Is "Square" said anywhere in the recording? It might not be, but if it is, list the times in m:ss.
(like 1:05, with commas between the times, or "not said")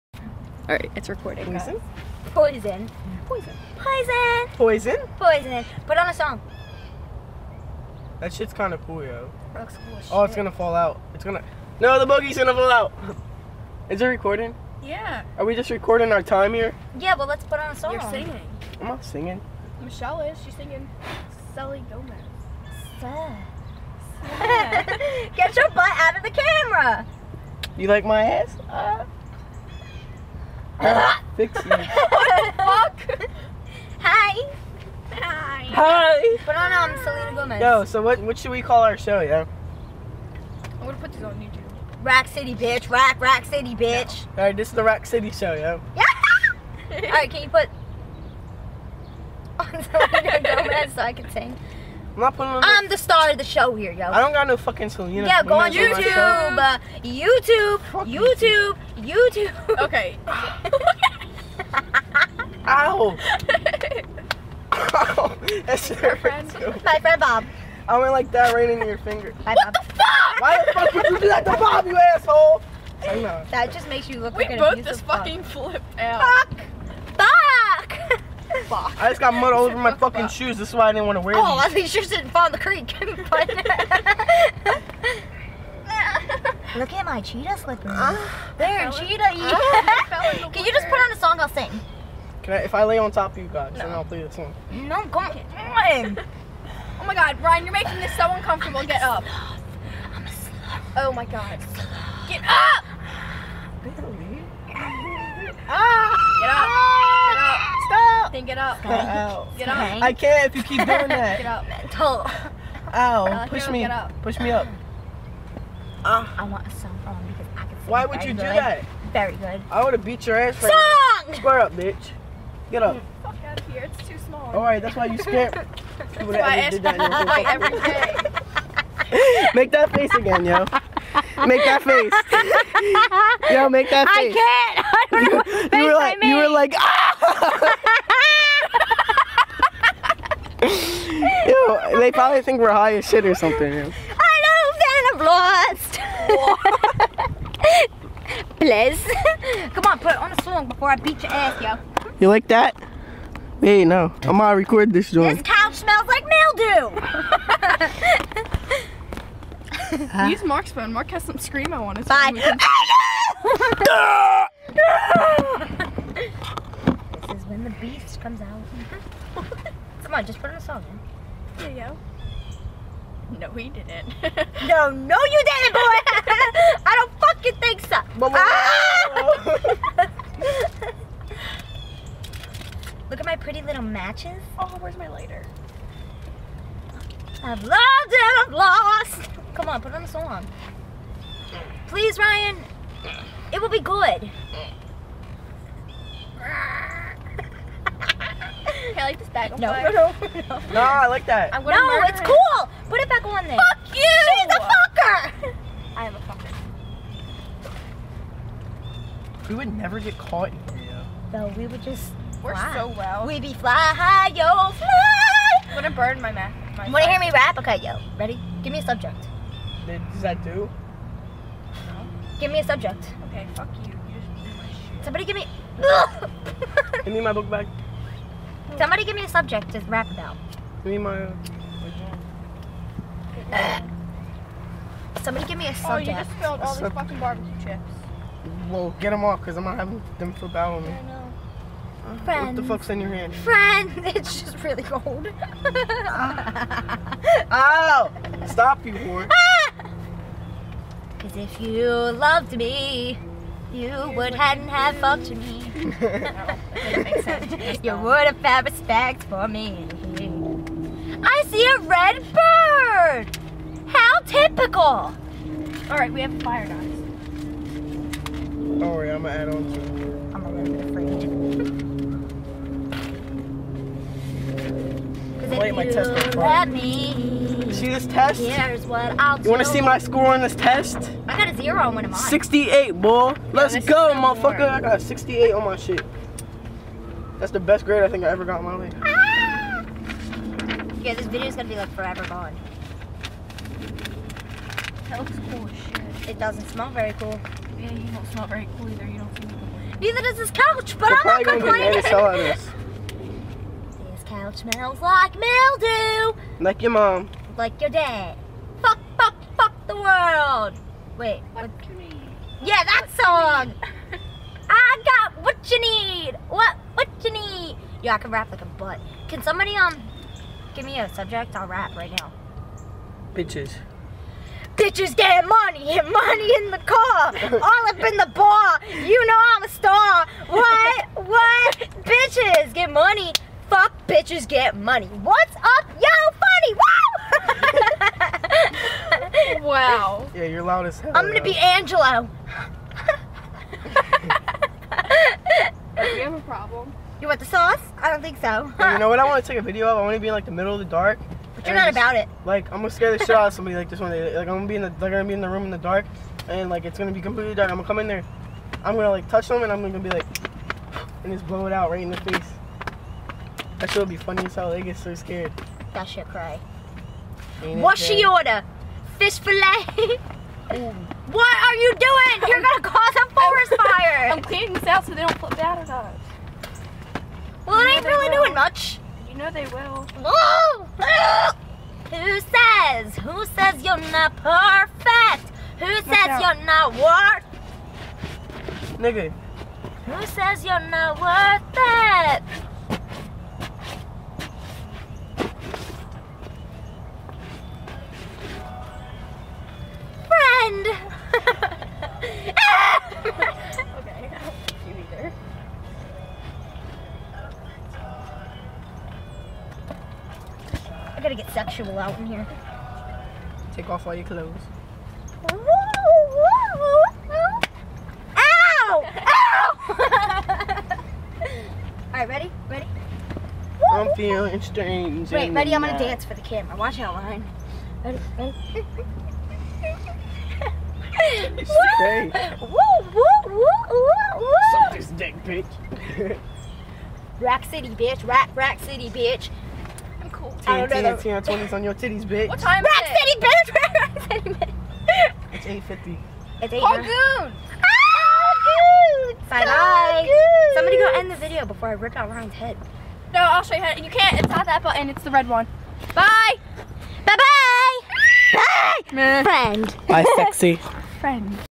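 2:01.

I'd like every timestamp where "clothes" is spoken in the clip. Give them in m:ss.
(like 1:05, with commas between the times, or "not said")
6:54.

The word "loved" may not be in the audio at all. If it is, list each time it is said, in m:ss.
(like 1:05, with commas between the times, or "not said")
3:07, 4:11.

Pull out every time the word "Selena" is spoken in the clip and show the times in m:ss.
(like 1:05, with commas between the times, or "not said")
0:37, 0:49, 0:54.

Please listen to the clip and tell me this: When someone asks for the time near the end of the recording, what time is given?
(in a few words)
8:50.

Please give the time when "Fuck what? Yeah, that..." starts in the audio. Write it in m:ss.
5:11.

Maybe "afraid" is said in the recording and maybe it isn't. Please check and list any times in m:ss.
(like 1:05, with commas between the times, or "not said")
4:30.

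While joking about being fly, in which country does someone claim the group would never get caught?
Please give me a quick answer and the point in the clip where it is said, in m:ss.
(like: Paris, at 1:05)
Korea, at 3:30.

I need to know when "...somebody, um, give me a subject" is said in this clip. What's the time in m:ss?
5:19.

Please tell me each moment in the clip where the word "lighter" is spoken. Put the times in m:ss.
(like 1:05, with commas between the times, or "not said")
3:05.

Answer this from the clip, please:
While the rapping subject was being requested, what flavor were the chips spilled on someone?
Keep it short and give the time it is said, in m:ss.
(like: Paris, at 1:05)
Barbecue, at 3:57.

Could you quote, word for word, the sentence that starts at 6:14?
I'm cleaning this out so they don't flip out at us.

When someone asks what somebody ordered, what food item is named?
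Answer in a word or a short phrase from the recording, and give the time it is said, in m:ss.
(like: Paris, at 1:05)
Fish fillet, at 6:09.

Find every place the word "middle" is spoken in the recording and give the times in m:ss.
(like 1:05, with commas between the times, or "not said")
5:50.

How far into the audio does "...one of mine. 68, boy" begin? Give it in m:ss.
4:41.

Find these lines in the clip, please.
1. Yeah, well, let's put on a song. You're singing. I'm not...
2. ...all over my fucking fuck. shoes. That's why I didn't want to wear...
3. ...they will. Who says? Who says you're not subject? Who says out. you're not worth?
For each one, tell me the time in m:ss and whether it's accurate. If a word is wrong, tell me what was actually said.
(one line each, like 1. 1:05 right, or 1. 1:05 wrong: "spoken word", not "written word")
1. 0:16 right
2. 1:19 right
3. 6:19 wrong: "perfect", not "subject".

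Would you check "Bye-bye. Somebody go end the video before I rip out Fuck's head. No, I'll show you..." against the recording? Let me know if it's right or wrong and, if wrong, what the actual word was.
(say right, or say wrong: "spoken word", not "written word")
wrong: "Ryan", not "Fuck".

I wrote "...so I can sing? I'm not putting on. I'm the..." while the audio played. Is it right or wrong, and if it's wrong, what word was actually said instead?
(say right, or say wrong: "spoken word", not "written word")
right.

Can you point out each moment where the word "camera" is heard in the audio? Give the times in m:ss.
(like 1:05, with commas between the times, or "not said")
0:26, 7:06.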